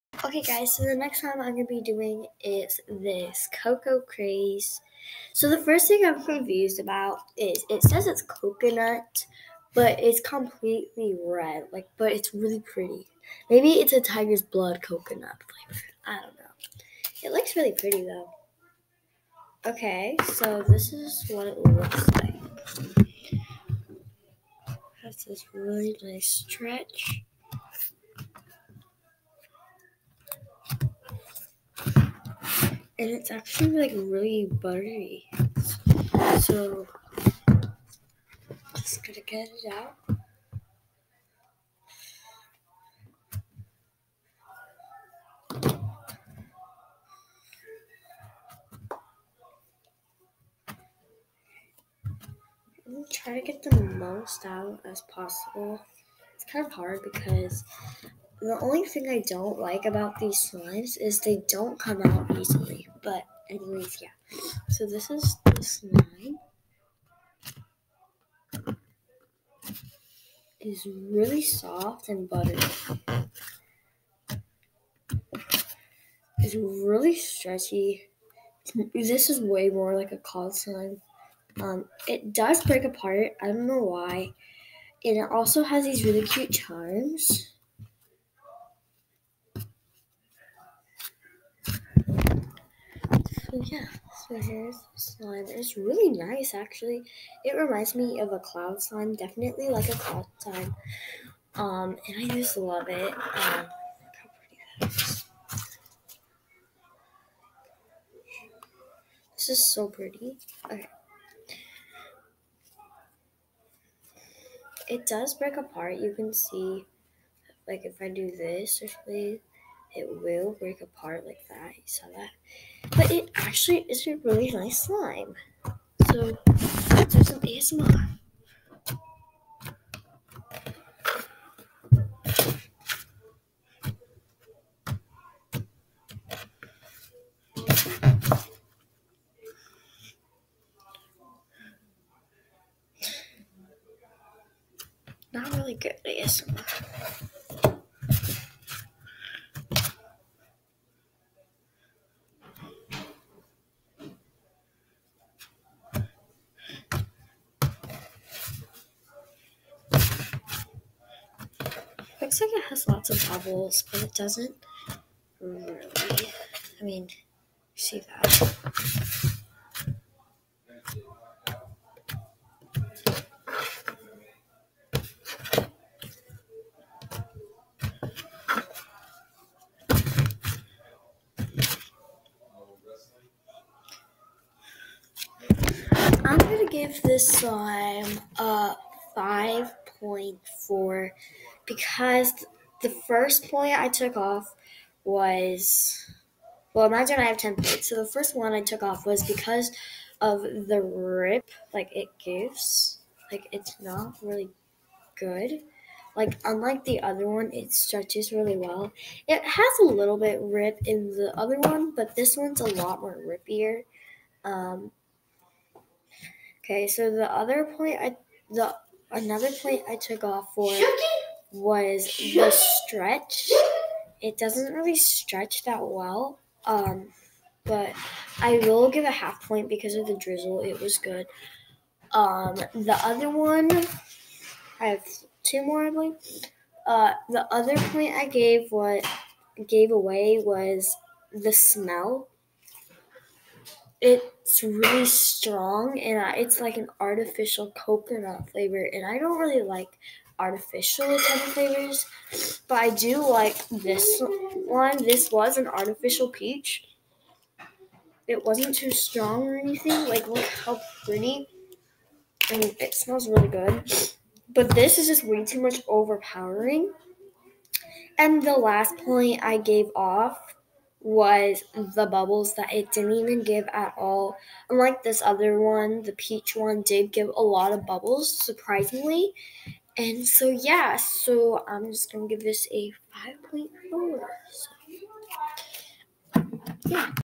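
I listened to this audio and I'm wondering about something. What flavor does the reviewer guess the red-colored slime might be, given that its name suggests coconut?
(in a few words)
Tiger's blood coconut.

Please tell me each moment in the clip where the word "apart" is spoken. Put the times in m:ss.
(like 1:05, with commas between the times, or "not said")
1:22, 1:55, 2:00.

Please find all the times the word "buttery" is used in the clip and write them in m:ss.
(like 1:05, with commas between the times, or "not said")
0:34, 1:12.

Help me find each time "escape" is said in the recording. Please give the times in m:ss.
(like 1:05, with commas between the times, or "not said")
not said.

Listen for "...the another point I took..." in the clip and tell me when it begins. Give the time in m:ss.
3:38.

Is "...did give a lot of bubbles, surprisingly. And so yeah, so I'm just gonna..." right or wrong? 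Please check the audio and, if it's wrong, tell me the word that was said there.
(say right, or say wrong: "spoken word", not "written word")
right.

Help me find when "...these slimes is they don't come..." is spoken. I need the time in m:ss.
1:00.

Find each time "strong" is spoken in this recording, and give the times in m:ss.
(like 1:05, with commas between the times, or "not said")
4:05, 4:18.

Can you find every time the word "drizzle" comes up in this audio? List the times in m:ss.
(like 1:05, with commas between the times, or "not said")
3:50.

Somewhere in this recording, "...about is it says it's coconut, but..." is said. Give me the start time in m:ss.
0:06.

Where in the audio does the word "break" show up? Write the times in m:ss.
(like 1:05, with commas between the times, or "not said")
1:22, 1:55, 2:00.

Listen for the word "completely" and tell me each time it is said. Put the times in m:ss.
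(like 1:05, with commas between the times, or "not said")
0:10.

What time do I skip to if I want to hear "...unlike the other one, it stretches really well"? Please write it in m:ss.
3:26.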